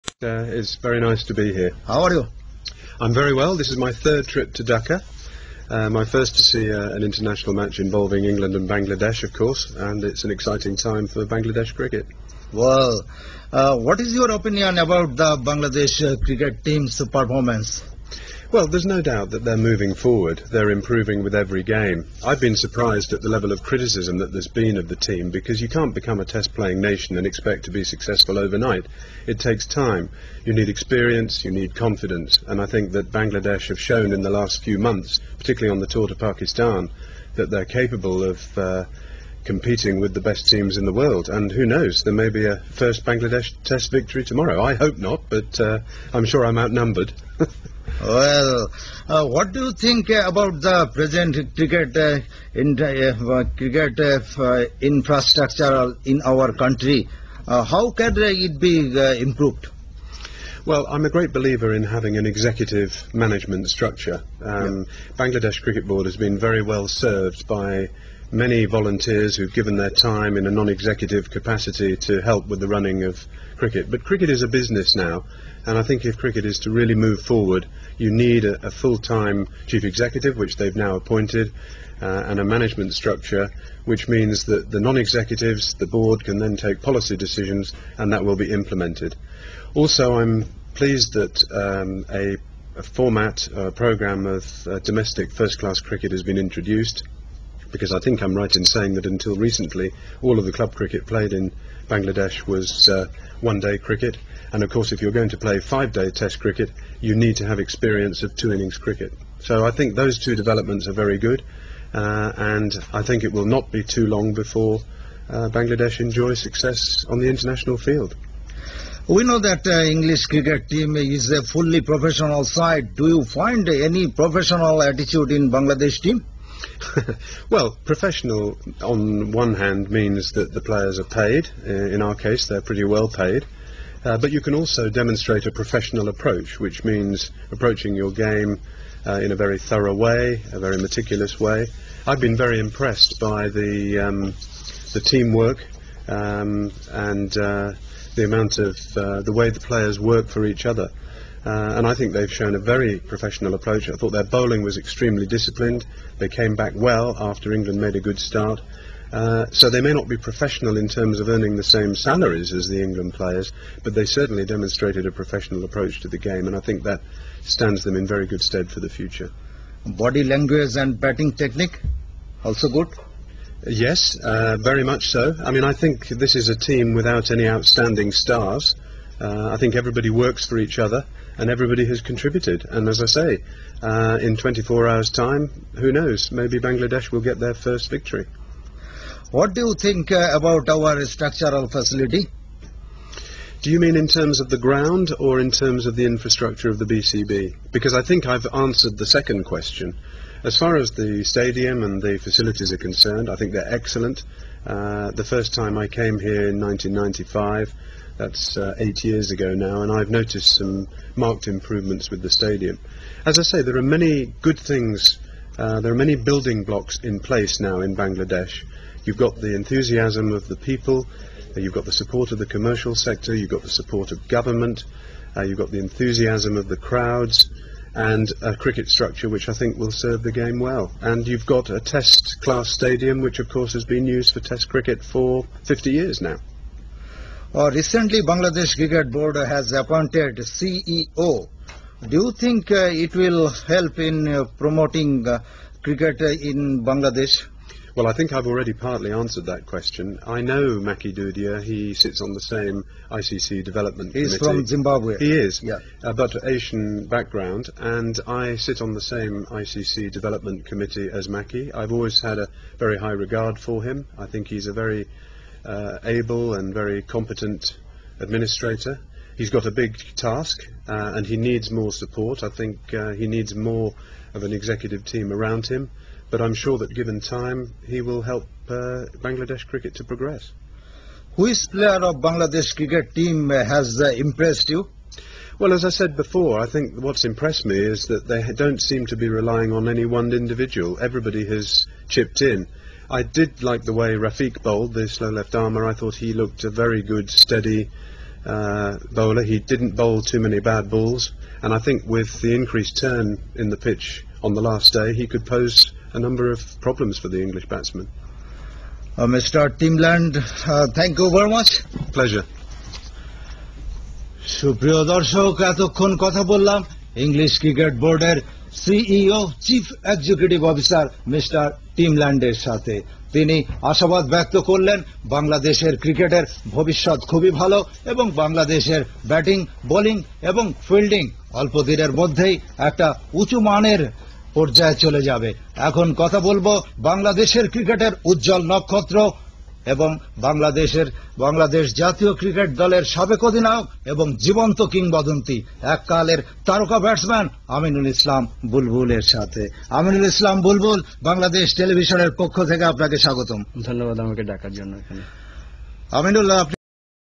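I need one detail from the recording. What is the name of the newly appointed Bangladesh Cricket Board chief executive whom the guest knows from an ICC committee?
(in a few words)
Maki Dudhia.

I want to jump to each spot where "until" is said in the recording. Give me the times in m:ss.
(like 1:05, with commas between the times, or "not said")
1:39.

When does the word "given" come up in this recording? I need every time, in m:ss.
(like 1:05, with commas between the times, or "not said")
1:09, 4:36.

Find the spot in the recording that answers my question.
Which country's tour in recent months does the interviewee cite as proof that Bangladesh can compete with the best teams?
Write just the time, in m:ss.
0:36.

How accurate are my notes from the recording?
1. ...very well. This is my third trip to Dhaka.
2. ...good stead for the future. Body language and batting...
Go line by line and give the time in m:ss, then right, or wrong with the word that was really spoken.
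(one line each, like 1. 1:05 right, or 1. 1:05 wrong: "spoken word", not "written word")
1. 0:03 right
2. 2:48 right.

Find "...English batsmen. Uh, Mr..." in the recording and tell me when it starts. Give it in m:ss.
5:07.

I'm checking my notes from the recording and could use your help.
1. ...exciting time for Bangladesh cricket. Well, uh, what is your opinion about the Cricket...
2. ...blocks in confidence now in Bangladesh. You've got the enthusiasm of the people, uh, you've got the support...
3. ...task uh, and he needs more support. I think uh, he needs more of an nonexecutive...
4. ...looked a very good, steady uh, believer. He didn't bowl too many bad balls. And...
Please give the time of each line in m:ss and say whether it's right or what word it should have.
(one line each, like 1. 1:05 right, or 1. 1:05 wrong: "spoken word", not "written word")
1. 0:10 wrong: "Bangladesh", not "Cricket"
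2. 3:36 wrong: "place", not "confidence"
3. 4:30 wrong: "executive", not "nonexecutive"
4. 4:56 wrong: "bowler", not "believer".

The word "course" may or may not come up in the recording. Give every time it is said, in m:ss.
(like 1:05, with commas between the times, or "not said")
0:09, 1:44, 3:53.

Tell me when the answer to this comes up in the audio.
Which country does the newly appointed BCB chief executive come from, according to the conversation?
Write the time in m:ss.
4:14.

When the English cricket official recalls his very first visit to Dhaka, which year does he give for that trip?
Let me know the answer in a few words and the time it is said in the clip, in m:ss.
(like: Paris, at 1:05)
1995, at 3:26.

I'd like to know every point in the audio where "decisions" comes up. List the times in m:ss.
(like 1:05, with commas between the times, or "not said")
1:27.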